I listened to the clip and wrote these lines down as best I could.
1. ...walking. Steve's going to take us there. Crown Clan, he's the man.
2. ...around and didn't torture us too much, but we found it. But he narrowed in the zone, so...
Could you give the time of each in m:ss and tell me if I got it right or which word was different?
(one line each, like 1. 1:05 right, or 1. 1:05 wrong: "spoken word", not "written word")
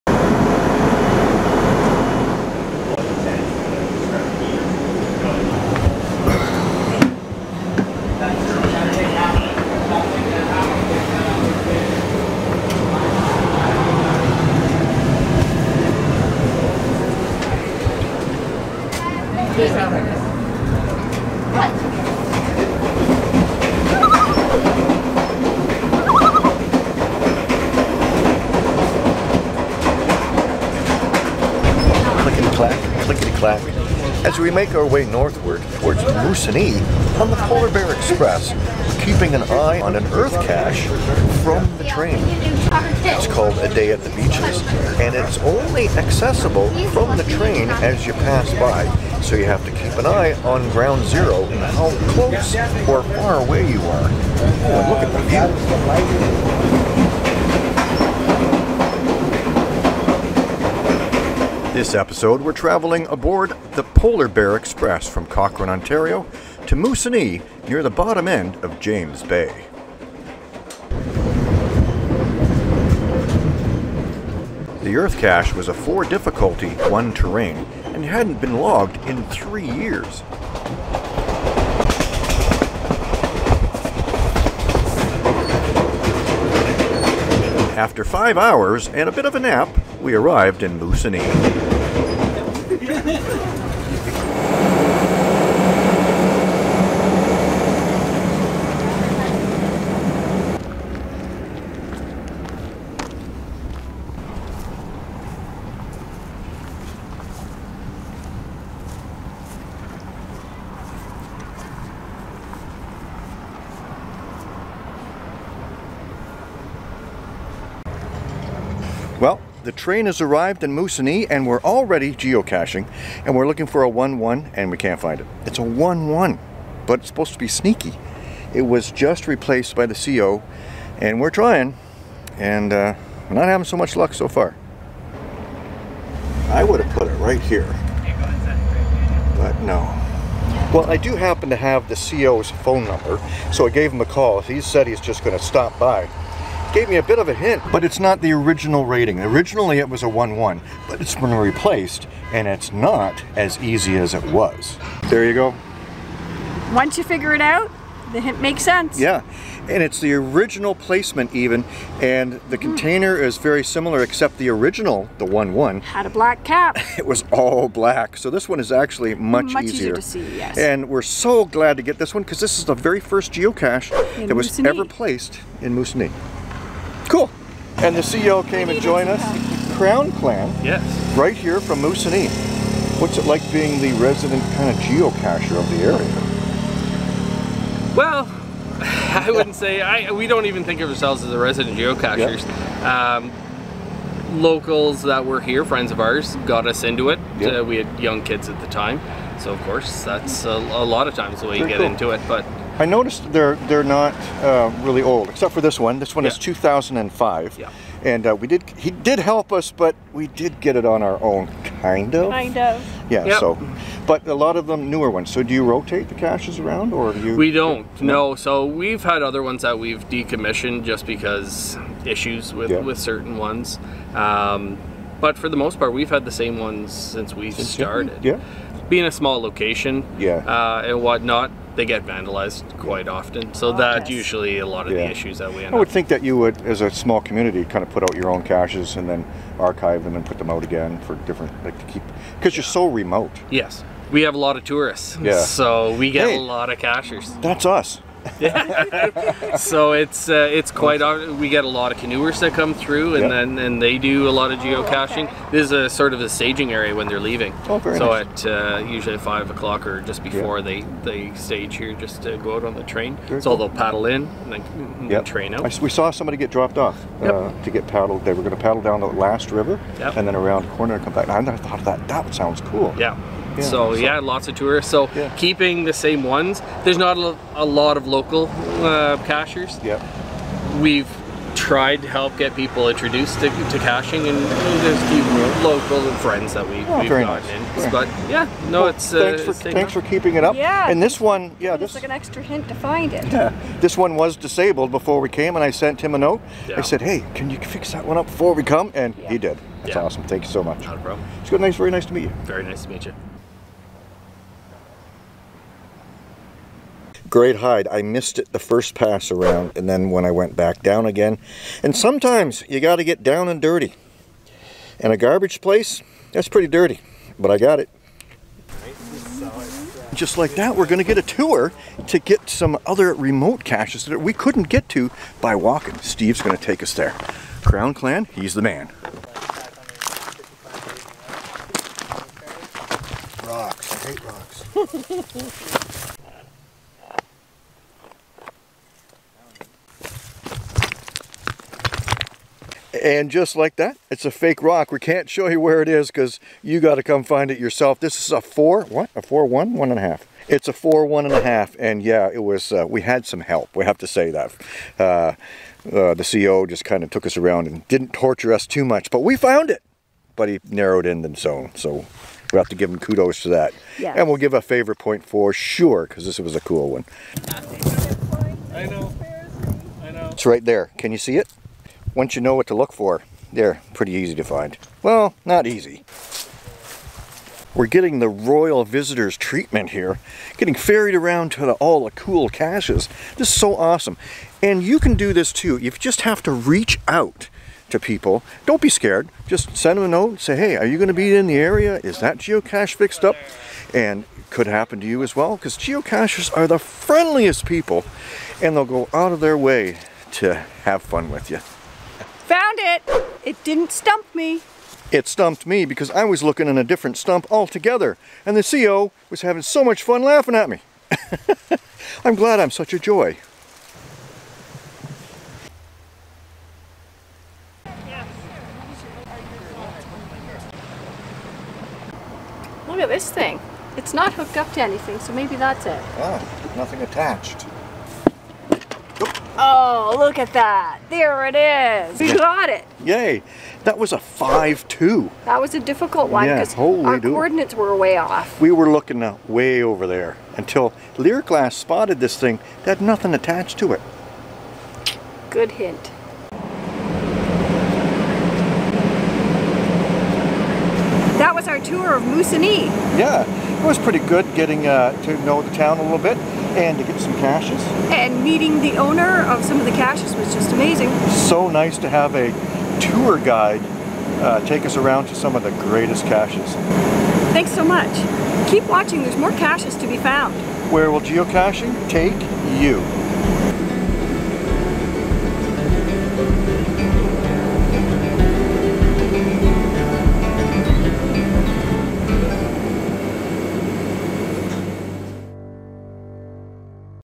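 1. 5:25 right
2. 5:57 right.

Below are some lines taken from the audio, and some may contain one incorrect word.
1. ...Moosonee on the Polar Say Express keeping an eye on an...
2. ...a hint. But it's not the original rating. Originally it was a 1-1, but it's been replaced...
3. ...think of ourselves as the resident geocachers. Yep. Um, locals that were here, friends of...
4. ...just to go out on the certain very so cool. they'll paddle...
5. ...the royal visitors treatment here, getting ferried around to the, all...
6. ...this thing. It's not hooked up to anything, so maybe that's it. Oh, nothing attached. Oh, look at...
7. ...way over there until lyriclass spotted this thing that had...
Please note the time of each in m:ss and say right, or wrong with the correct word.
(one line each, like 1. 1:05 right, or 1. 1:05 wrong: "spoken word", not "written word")
1. 0:36 wrong: "Bear", not "Say"
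2. 2:27 right
3. 3:10 right
4. 4:21 wrong: "train", not "certain"
5. 6:18 right
6. 7:03 right
7. 7:19 right.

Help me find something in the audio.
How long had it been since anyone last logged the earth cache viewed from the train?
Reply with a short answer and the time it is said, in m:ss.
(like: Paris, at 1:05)
3 years, at 1:19.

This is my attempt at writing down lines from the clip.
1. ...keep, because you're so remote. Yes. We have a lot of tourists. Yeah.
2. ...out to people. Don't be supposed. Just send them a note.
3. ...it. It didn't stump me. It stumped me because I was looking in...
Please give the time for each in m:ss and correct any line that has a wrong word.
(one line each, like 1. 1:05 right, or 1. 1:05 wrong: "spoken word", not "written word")
1. 4:01 right
2. 6:27 wrong: "scared", not "supposed"
3. 6:42 right.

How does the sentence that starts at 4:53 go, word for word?
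Yeah, this one was disabled before we came, and I sent him a note.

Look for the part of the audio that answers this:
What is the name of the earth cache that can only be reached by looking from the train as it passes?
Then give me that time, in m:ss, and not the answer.
0:43.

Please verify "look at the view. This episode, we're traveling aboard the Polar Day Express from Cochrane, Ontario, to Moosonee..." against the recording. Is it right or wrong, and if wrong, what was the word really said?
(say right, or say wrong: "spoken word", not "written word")
wrong: "Bear", not "Day".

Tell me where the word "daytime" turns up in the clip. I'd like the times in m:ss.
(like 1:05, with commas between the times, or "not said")
not said.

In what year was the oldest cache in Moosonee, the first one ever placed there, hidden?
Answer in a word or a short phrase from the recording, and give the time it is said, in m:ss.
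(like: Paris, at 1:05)
2005, at 3:26.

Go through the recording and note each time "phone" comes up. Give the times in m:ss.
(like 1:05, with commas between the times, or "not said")
2:22.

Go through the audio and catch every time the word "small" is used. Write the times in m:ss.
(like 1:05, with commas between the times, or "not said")
3:49, 3:56.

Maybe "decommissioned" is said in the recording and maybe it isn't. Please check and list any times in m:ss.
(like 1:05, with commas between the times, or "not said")
3:40.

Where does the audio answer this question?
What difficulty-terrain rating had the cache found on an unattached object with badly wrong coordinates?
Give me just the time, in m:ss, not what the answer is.
7:14.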